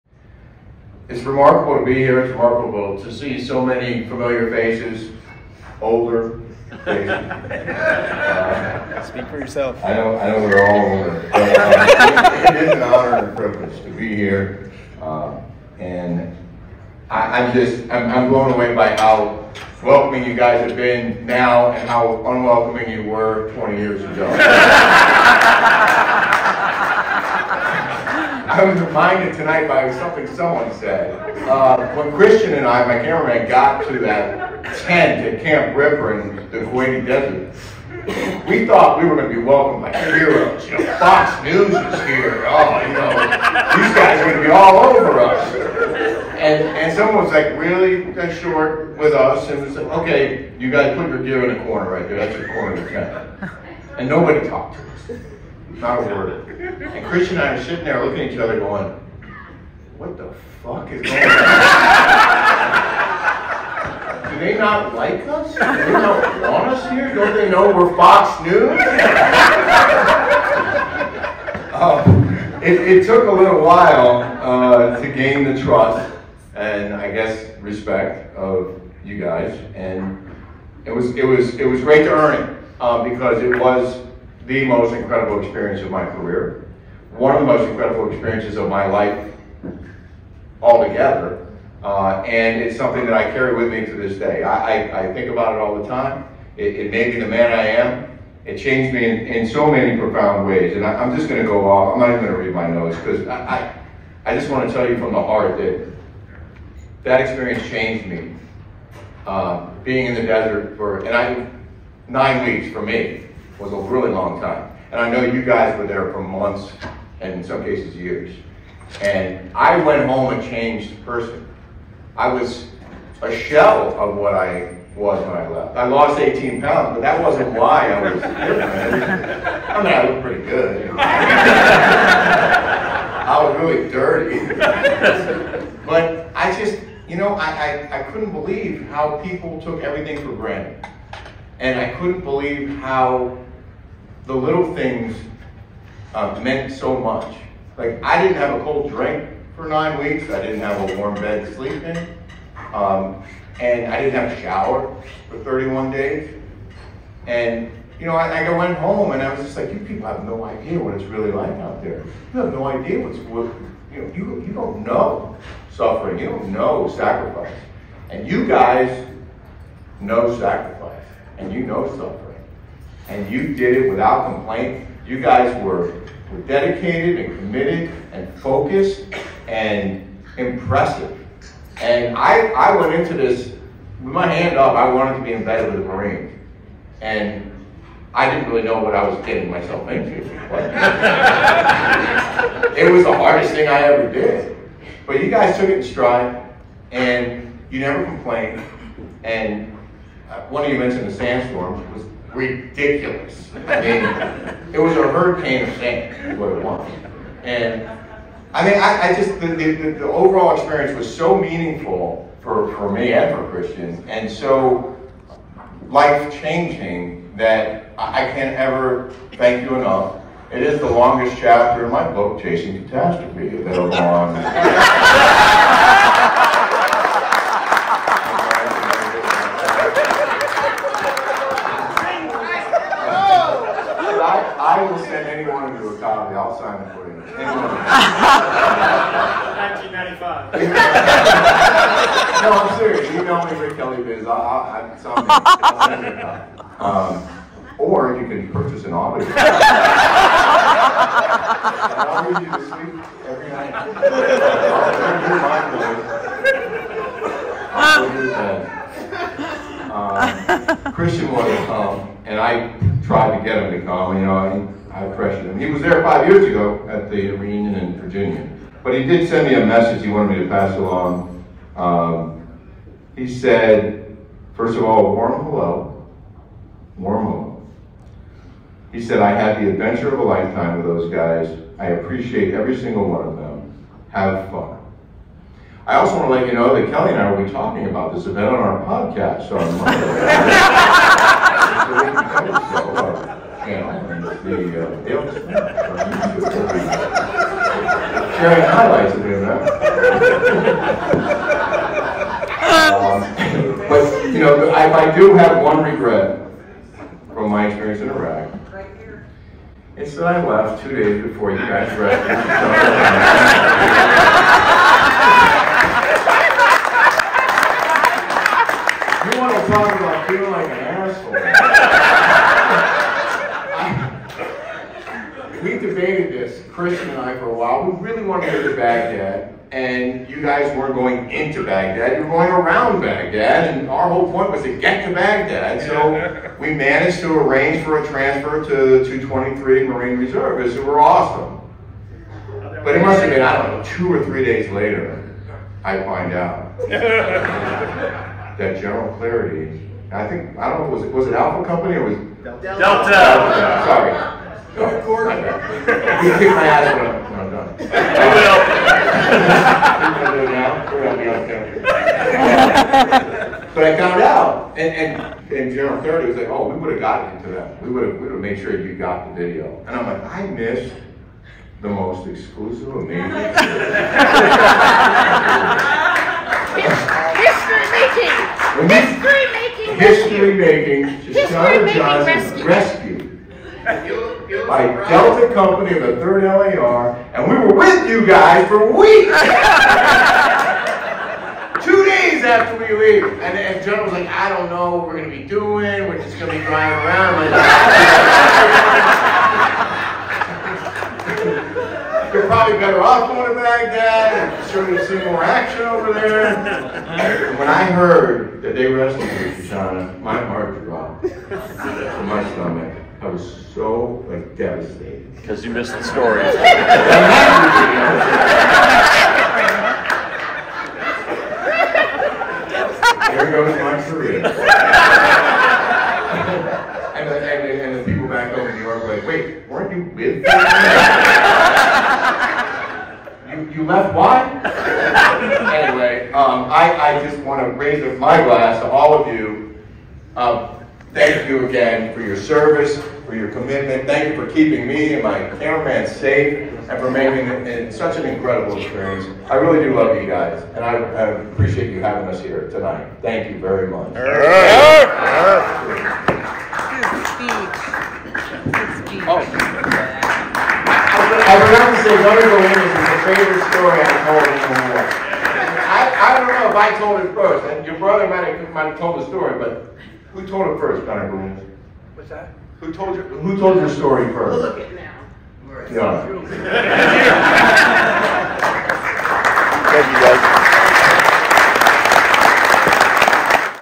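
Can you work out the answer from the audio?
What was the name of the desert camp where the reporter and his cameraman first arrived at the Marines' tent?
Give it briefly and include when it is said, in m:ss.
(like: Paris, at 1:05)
Camp Ripper, at 0:35.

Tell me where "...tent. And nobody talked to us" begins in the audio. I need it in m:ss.
0:52.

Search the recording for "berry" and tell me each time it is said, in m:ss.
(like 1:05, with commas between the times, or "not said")
not said.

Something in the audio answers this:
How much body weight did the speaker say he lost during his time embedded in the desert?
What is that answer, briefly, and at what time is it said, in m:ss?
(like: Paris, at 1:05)
18 pounds, at 2:06.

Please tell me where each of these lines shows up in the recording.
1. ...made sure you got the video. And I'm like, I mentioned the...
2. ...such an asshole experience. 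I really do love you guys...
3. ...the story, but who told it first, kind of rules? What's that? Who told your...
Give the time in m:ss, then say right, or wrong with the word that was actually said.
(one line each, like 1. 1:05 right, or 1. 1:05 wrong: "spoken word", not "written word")
1. 6:08 wrong: "missed", not "mentioned"
2. 7:27 wrong: "incredible", not "asshole"
3. 7:49 right.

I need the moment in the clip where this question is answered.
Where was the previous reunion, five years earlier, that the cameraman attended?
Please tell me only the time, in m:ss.
4:27.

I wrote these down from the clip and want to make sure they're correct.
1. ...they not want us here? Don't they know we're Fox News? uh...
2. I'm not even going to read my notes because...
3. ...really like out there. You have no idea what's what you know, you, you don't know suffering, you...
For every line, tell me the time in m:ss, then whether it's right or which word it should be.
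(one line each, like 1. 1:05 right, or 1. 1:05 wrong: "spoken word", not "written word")
1. 1:05 right
2. 1:41 right
3. 2:41 right.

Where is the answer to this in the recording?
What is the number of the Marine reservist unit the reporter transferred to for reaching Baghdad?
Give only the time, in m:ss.
5:39.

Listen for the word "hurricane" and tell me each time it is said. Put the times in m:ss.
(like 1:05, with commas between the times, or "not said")
3:25.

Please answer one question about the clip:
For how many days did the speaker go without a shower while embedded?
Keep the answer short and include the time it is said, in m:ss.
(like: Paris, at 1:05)
31, at 2:35.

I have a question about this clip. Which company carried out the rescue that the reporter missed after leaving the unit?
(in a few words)
Delta Company.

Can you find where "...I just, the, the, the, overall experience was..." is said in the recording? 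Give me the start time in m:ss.
3:29.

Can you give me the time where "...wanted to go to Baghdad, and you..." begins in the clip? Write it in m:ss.
5:28.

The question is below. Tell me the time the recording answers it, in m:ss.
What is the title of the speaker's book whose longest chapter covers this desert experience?
3:42.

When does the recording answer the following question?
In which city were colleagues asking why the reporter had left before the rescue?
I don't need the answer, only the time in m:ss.
7:08.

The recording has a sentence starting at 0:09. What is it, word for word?
I know, I know we're all older.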